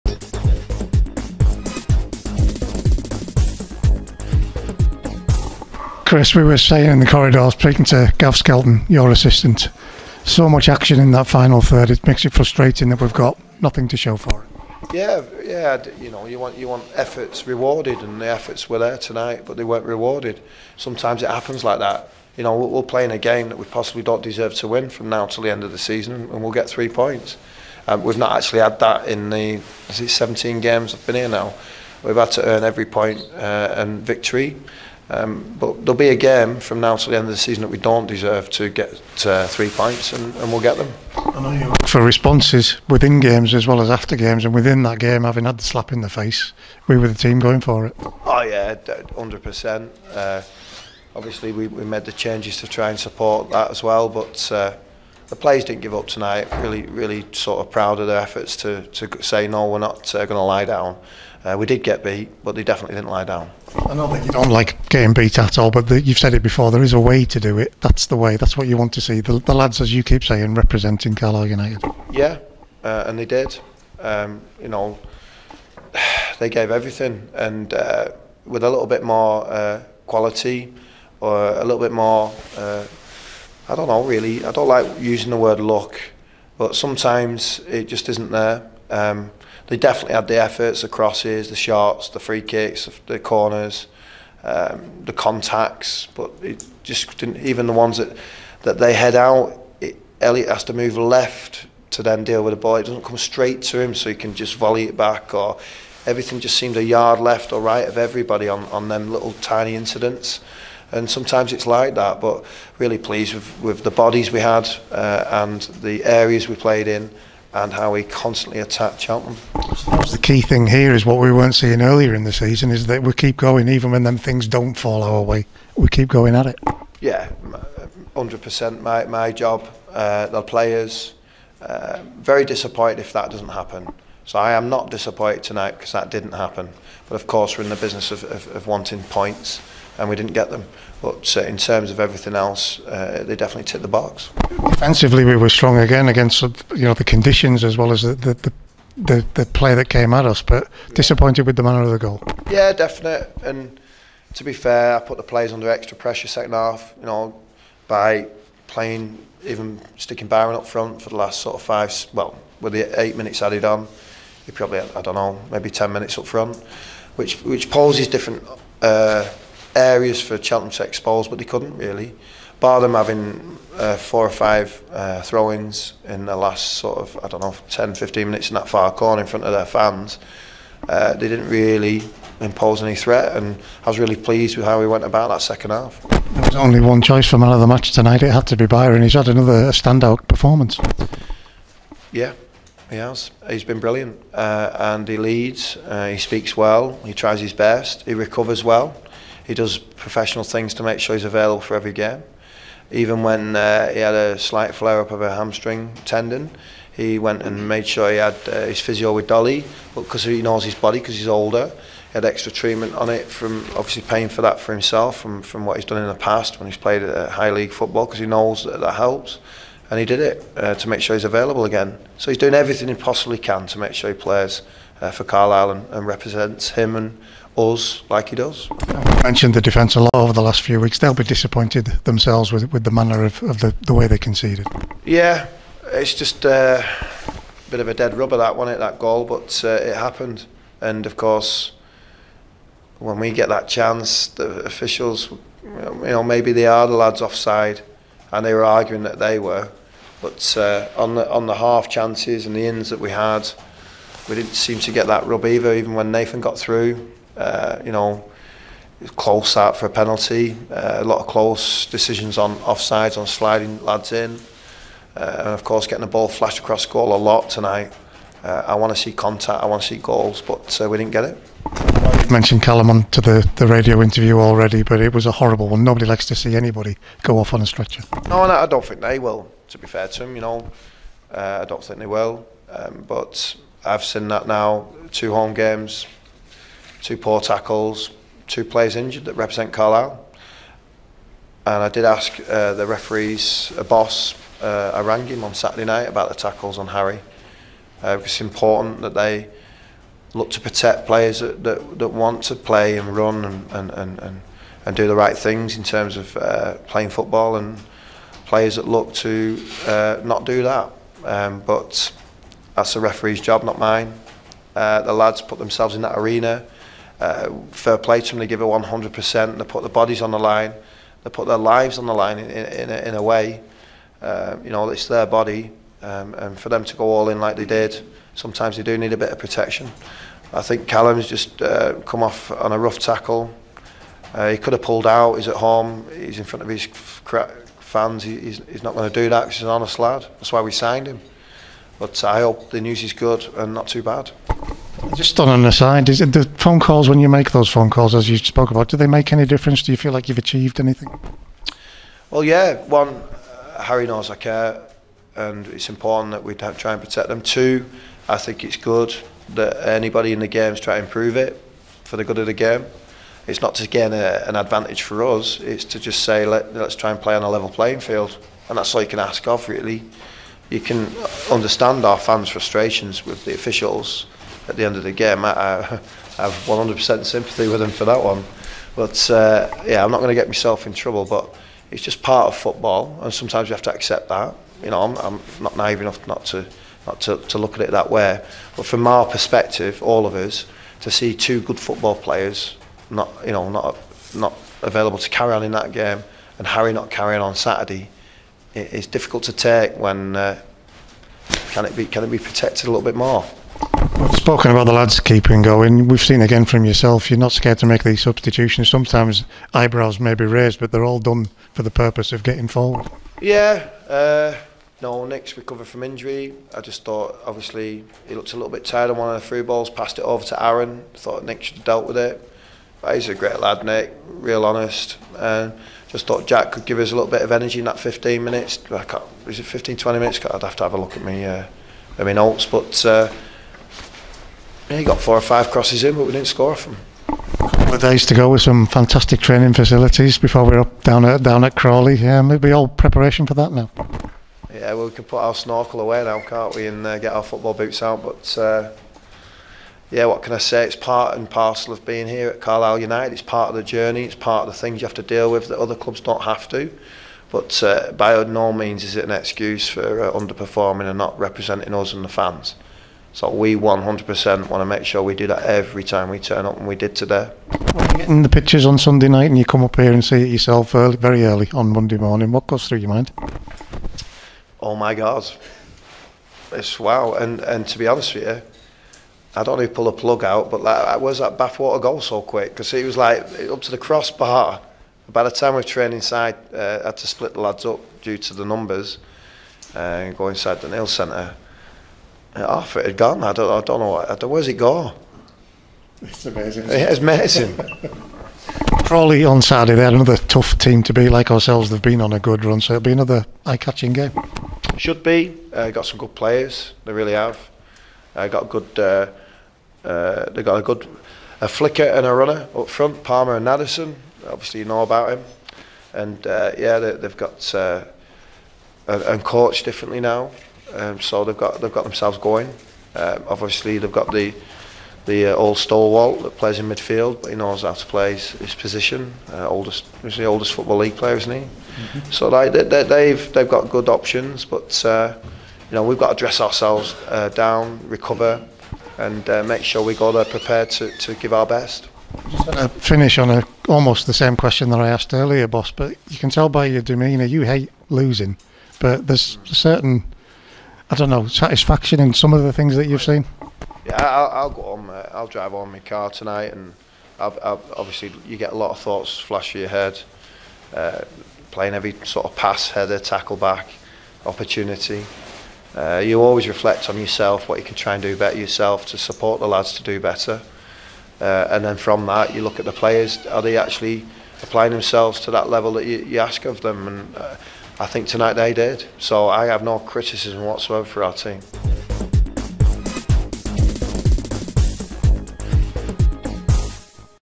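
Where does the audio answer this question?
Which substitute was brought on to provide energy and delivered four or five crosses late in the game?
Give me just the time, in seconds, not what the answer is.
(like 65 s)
426 s.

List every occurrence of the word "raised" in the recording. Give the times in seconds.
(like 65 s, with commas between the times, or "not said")
410 s.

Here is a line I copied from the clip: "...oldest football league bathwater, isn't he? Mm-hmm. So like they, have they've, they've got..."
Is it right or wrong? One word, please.
wrong.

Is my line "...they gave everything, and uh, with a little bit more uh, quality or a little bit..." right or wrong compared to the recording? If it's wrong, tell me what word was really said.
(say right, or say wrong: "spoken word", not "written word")
right.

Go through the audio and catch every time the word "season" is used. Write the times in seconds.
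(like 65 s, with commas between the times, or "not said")
25 s, 37 s, 122 s.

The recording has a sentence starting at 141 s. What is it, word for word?
But uh, in terms of everything else, uh, they definitely ticked the box.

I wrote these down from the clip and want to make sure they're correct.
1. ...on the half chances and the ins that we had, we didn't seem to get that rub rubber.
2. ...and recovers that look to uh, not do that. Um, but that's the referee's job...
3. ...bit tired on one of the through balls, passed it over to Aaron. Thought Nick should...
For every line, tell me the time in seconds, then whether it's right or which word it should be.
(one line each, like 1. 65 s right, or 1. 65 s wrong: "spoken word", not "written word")
1. 251 s wrong: "either", not "rubber"
2. 307 s wrong: "players", not "recovers"
3. 418 s right.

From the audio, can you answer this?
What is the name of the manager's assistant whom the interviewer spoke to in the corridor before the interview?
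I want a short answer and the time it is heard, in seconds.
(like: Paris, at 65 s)
Gav Skelton, at 8 s.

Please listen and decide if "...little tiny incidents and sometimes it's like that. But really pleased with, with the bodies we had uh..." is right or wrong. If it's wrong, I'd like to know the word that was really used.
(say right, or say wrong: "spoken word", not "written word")
right.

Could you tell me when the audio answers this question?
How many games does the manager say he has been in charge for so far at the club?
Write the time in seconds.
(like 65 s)
30 s.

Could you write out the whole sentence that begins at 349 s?
Do you feel like you've achieved anything?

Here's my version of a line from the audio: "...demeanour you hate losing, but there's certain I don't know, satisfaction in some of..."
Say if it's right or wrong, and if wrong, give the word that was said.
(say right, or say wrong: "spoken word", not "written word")
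right.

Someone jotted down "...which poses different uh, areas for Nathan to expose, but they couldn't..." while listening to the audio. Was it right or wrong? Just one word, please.
wrong.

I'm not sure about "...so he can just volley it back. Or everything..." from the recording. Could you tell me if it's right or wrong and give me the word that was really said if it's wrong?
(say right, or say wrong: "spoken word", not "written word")
right.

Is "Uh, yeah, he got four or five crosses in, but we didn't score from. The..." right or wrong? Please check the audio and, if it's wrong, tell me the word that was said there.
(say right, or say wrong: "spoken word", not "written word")
right.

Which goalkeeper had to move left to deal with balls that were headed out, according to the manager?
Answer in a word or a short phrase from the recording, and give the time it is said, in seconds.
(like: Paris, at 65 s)
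Elliott, at 100 s.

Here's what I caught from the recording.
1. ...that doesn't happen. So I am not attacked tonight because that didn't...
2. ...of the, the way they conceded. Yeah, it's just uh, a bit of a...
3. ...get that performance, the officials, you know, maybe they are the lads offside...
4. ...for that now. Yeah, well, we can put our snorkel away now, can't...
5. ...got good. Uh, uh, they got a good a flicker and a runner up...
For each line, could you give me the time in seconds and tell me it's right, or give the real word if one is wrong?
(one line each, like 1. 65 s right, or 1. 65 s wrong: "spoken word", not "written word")
1. 133 s wrong: "disappointed", not "attacked"
2. 233 s right
3. 243 s wrong: "chance", not "performance"
4. 443 s right
5. 508 s right.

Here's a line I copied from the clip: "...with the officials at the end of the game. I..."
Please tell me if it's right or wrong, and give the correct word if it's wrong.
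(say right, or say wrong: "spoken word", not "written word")
right.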